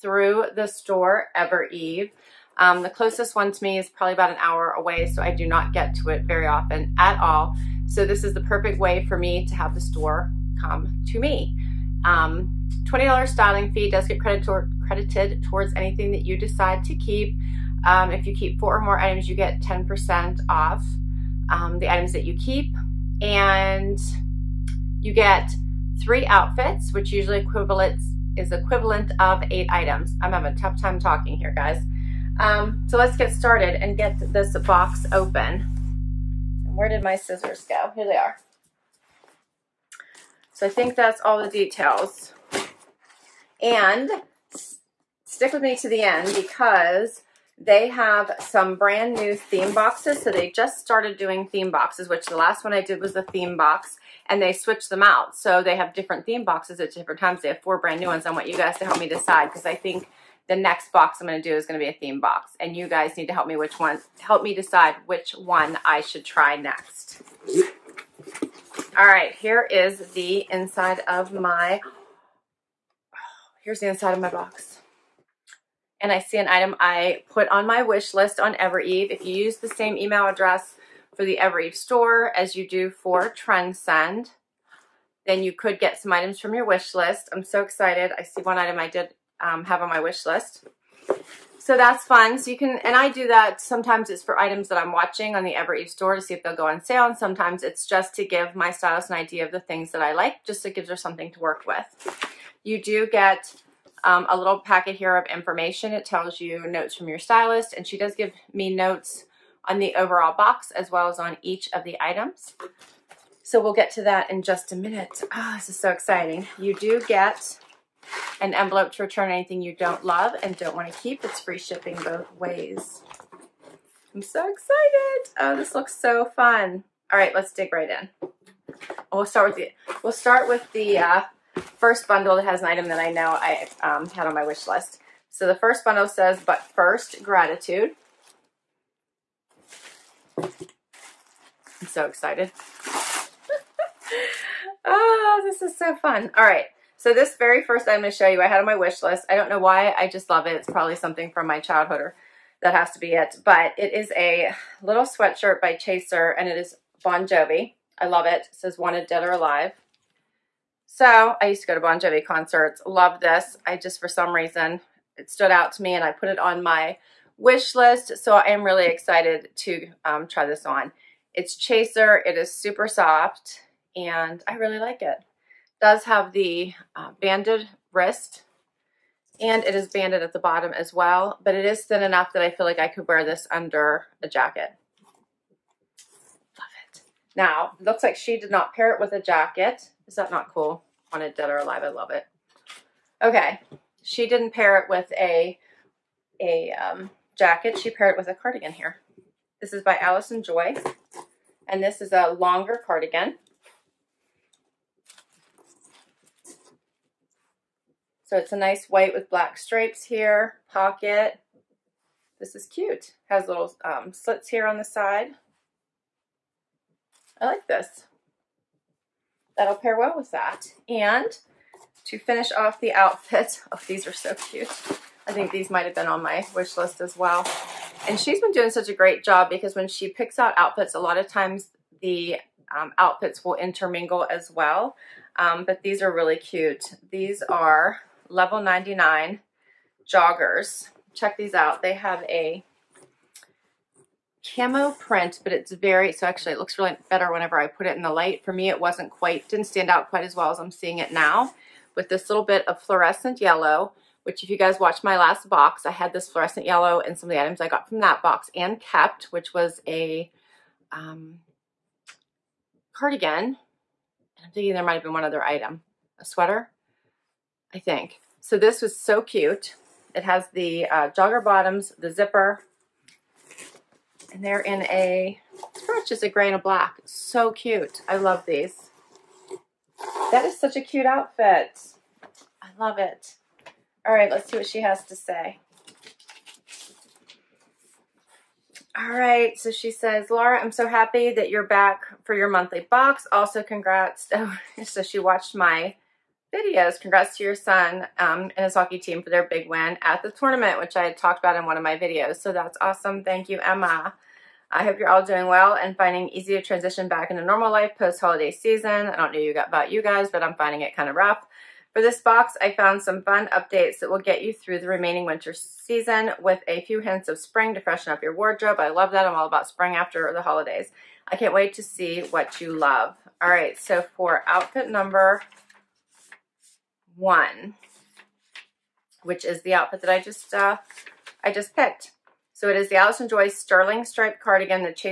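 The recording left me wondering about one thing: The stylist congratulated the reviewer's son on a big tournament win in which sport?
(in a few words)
Hockey.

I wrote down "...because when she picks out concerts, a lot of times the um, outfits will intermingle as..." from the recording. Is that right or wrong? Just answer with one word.
wrong.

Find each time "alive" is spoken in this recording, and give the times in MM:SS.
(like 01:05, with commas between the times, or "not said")
02:39, 03:11.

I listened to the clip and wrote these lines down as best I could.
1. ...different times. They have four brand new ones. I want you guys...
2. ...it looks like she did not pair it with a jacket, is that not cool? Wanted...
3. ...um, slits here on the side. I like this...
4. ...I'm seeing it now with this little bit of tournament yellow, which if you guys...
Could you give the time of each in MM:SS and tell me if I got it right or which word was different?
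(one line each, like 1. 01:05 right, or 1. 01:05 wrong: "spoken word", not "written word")
1. 00:56 right
2. 03:07 right
3. 03:33 right
4. 04:10 wrong: "fluorescent", not "tournament".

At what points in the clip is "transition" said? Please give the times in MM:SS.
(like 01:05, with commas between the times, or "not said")
05:06.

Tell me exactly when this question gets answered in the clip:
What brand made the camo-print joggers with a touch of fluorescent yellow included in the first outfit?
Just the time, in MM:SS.
03:58.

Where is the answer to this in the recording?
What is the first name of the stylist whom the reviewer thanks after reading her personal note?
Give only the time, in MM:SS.
05:03.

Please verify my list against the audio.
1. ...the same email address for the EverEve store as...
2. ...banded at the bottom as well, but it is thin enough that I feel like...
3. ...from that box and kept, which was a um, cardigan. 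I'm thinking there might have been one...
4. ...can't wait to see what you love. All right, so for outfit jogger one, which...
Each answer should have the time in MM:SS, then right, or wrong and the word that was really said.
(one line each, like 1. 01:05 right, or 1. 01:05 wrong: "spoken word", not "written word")
1. 01:19 right
2. 02:59 right
3. 04:17 right
4. 05:21 wrong: "number", not "jogger".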